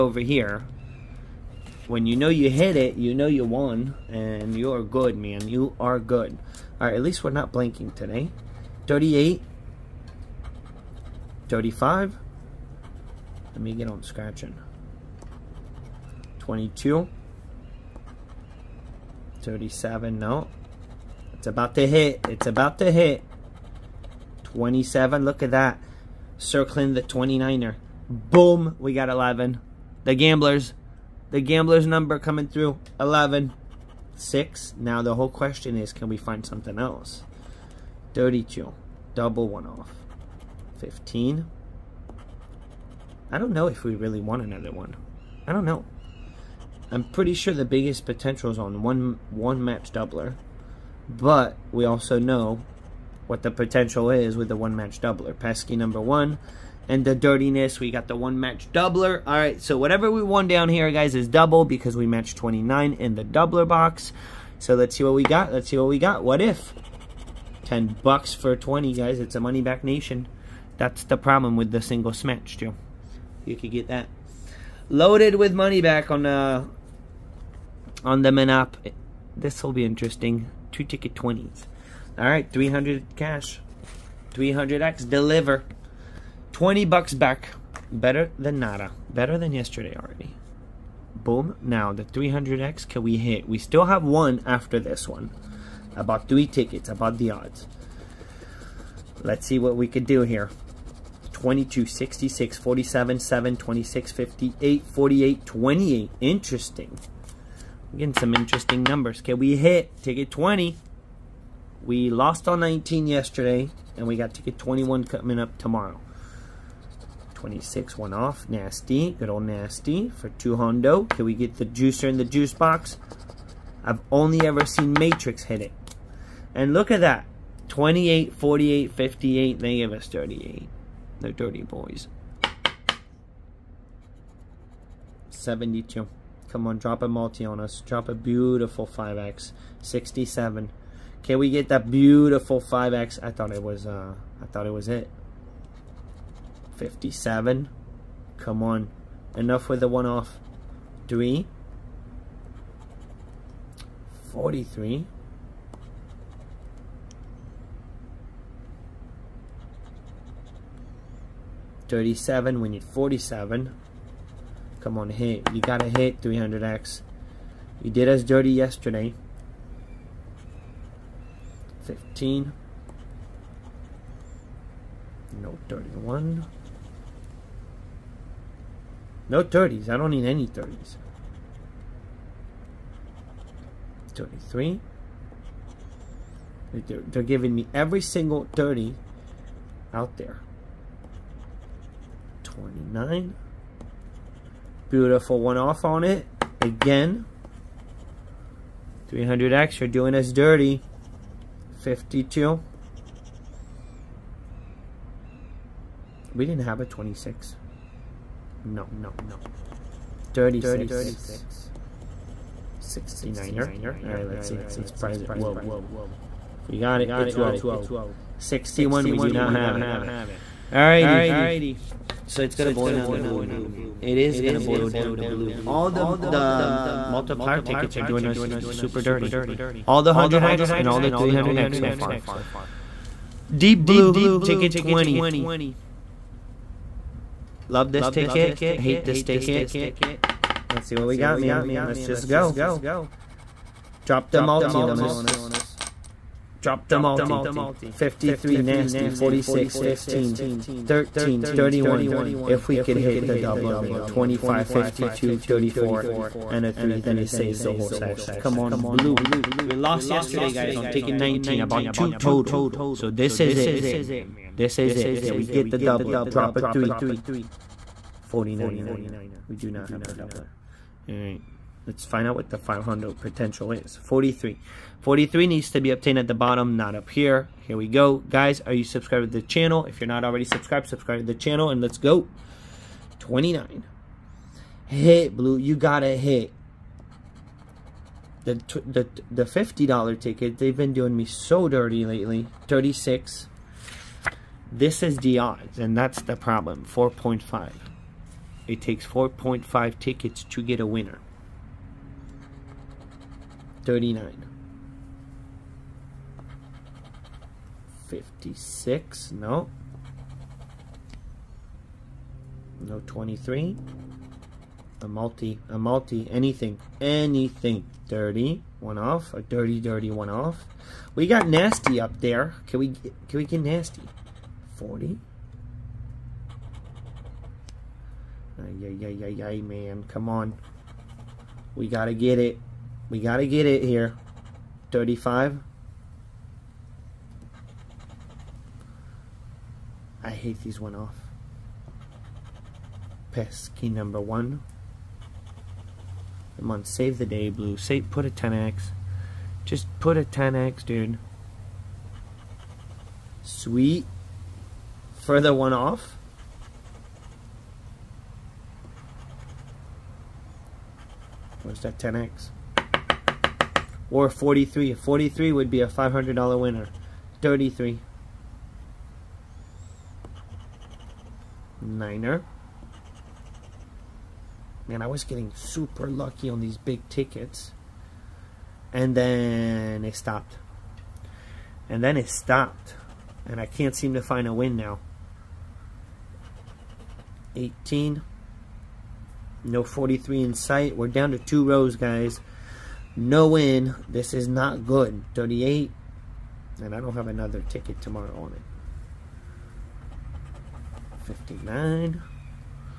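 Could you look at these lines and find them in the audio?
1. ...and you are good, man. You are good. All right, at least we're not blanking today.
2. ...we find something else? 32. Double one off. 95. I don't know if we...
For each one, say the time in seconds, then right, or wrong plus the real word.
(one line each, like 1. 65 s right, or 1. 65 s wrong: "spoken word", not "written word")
1. 4 s right
2. 36 s wrong: "15", not "95".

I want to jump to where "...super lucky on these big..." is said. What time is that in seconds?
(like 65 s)
375 s.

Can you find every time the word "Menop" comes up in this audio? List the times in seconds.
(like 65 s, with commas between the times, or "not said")
78 s.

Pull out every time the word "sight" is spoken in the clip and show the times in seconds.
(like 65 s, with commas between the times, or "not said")
390 s.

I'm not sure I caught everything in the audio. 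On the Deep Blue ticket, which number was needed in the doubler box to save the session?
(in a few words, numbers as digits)
3.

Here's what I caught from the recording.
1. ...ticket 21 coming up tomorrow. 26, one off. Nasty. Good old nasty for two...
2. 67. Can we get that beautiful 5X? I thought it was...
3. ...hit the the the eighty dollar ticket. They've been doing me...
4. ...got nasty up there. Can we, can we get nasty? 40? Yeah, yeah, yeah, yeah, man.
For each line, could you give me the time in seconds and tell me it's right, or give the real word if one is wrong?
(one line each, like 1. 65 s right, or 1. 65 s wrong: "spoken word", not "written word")
1. 114 s right
2. 139 s right
3. 286 s wrong: "fifty", not "eighty"
4. 321 s right.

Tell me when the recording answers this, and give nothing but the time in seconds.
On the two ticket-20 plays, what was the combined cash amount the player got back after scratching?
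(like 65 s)
86 s.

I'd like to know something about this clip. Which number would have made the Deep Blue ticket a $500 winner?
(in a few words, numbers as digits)
43.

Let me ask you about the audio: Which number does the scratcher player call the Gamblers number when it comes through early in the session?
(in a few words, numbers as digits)
11.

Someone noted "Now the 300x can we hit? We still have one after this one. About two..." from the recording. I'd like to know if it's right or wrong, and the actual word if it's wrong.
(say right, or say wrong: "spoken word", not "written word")
wrong: "three", not "two".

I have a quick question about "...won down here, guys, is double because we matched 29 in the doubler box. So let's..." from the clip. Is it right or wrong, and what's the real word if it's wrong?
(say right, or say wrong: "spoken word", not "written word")
right.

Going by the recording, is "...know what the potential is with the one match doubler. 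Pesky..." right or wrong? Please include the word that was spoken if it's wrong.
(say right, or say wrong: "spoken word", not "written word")
right.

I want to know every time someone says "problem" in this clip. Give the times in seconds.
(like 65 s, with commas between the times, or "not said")
71 s, 296 s.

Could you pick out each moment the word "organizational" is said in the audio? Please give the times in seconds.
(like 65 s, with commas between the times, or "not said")
not said.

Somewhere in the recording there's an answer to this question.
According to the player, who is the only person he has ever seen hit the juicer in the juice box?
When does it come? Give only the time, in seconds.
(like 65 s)
124 s.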